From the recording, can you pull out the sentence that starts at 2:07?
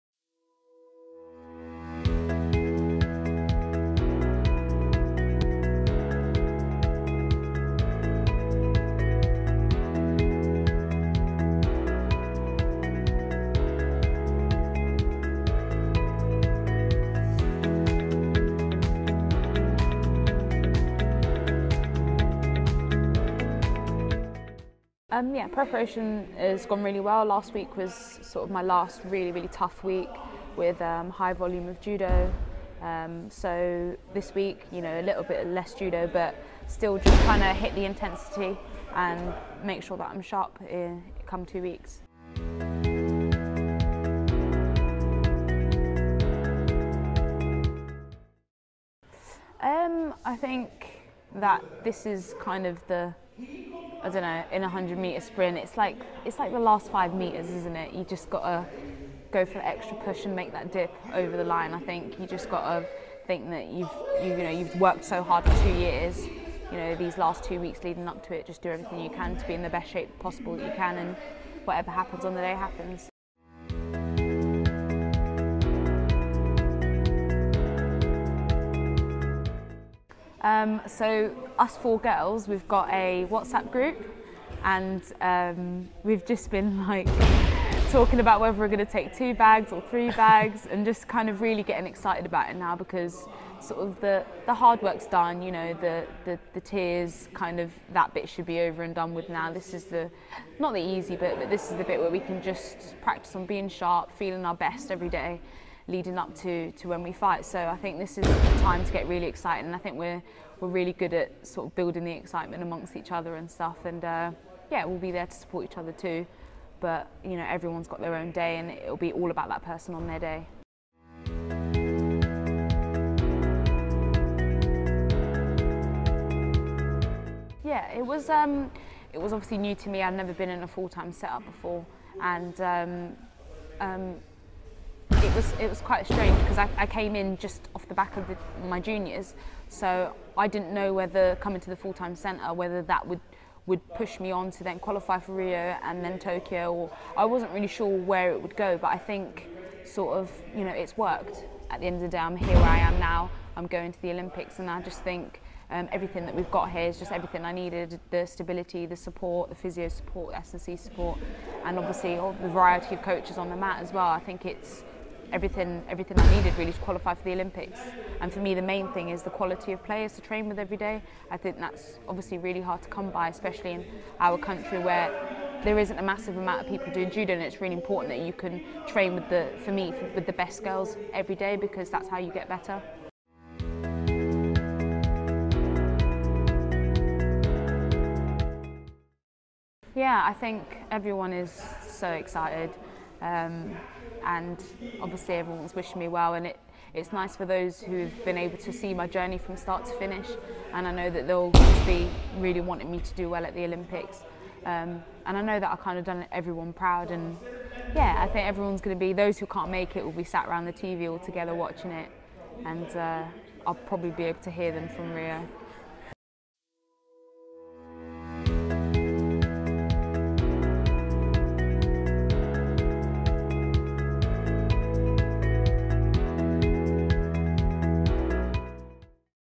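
Yeah, it was um, it was obviously new to me.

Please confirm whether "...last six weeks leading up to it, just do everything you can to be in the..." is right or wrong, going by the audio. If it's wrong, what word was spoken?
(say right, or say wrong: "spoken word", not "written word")
wrong: "two", not "six".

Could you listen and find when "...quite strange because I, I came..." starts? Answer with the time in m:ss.
2:15.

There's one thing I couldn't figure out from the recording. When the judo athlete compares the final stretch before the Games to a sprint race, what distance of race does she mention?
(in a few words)
100 meters.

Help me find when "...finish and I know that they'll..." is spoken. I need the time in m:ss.
3:19.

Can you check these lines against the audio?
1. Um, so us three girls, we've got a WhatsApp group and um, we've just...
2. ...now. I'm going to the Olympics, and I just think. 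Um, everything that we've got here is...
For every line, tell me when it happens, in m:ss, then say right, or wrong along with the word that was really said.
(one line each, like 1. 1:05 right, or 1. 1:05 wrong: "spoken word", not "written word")
1. 1:20 wrong: "four", not "three"
2. 2:32 right.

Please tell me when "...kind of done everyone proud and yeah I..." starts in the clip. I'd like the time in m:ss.
3:25.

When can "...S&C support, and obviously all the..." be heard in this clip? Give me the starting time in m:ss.
2:40.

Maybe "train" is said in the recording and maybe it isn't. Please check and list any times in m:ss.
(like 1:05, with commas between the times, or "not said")
2:50, 2:58.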